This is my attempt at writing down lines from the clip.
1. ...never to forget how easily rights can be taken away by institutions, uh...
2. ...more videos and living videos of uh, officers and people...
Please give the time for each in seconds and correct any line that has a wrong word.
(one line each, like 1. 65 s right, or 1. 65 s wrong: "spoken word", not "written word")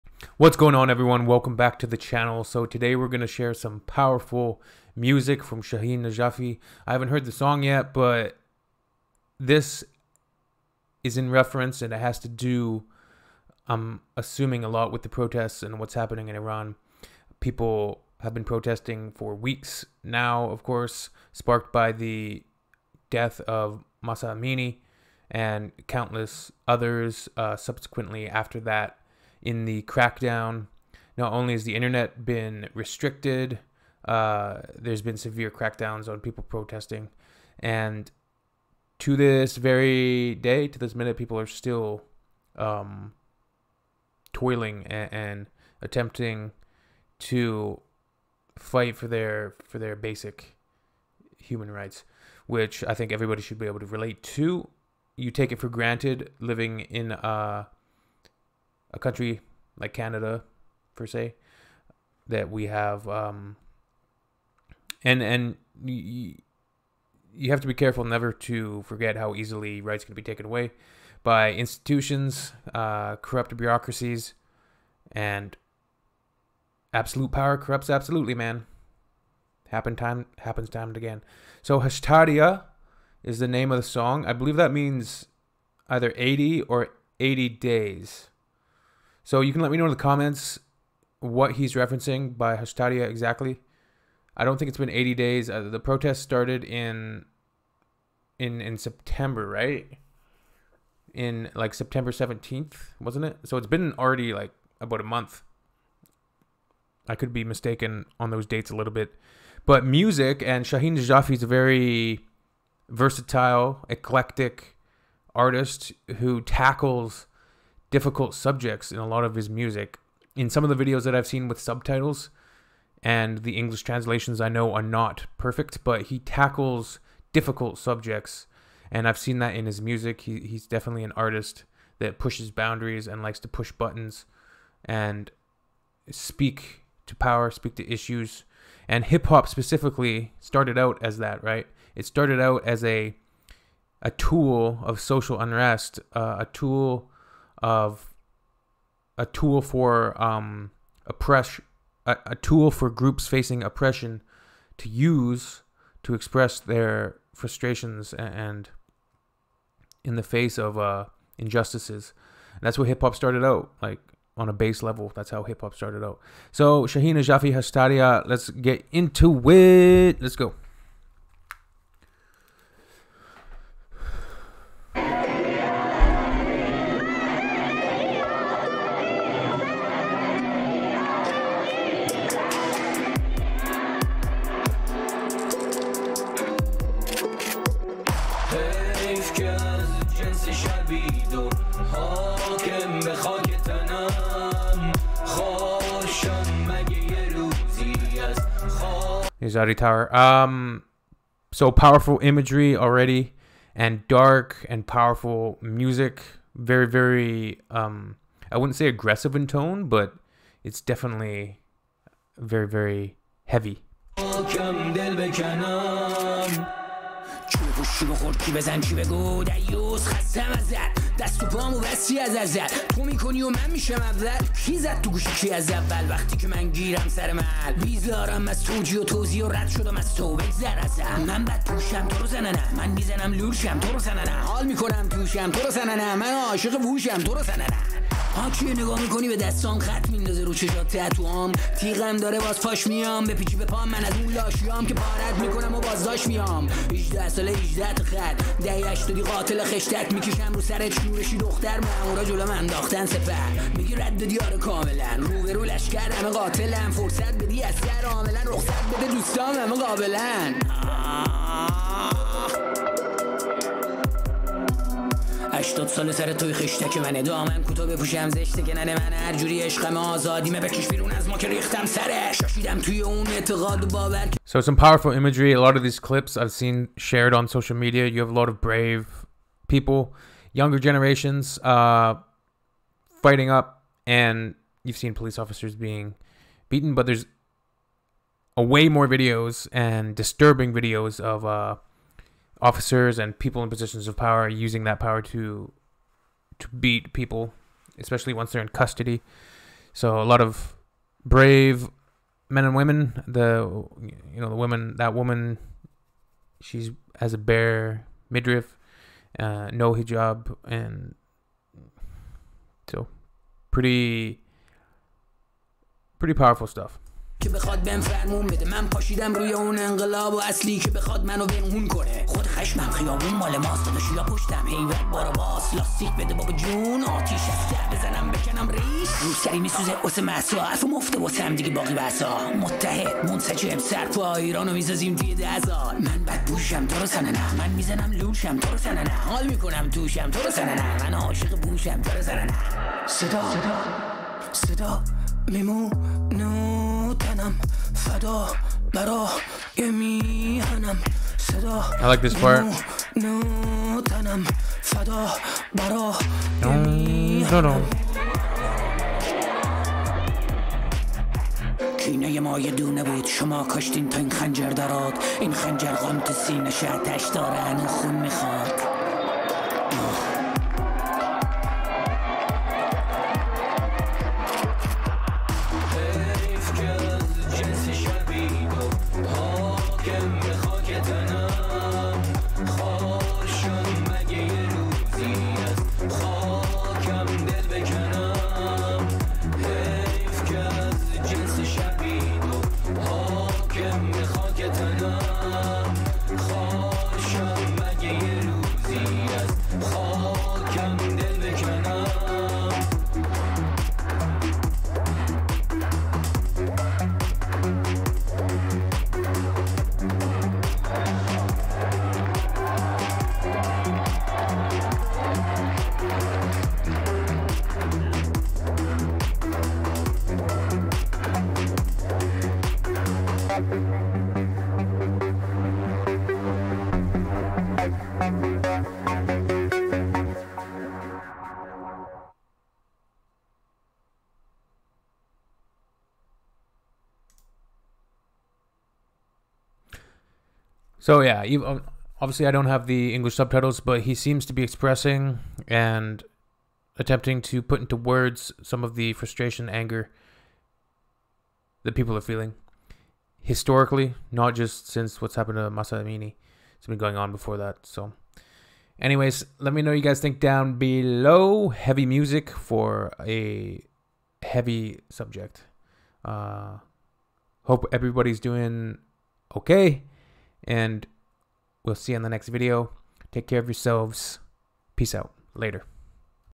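1. 68 s right
2. 288 s wrong: "disturbing", not "living".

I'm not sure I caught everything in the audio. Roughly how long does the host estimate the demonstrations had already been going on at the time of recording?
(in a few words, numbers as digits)
About a month.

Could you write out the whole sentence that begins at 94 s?
I don't think it's been 80 days.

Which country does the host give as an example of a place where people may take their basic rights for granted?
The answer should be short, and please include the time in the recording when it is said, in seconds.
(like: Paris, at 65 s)
Canada, at 59 s.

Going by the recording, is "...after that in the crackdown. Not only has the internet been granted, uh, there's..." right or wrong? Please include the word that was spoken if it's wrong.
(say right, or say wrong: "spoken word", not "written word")
wrong: "restricted", not "granted".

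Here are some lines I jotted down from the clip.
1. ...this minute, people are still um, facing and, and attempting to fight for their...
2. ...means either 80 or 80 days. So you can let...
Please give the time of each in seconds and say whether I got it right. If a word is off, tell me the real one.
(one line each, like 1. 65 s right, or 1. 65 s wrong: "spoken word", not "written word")
1. 40 s wrong: "toiling", not "facing"
2. 84 s right.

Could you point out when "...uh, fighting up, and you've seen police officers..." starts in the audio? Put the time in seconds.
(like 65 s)
281 s.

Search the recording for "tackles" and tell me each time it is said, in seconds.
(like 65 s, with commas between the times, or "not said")
116 s, 126 s.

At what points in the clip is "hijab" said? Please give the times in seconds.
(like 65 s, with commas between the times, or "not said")
309 s.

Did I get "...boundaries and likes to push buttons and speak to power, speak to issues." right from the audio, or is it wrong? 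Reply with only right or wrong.
right.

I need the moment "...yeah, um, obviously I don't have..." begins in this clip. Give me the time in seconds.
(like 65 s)
441 s.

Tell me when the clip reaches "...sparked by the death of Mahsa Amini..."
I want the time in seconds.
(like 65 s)
21 s.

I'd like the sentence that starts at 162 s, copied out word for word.
And that's what hip hop started out like on a base level.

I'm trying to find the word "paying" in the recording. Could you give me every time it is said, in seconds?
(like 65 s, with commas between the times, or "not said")
not said.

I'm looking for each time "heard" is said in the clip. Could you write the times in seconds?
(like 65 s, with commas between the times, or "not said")
7 s.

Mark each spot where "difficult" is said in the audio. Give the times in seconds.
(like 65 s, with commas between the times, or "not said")
117 s, 127 s.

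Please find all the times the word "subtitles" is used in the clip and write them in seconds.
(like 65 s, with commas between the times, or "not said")
121 s, 443 s.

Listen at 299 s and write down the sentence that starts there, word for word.
So a lot of brave men and women.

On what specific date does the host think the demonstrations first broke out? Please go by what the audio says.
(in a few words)
September 17th.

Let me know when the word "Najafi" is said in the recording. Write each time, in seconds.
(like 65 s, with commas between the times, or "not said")
6 s, 110 s.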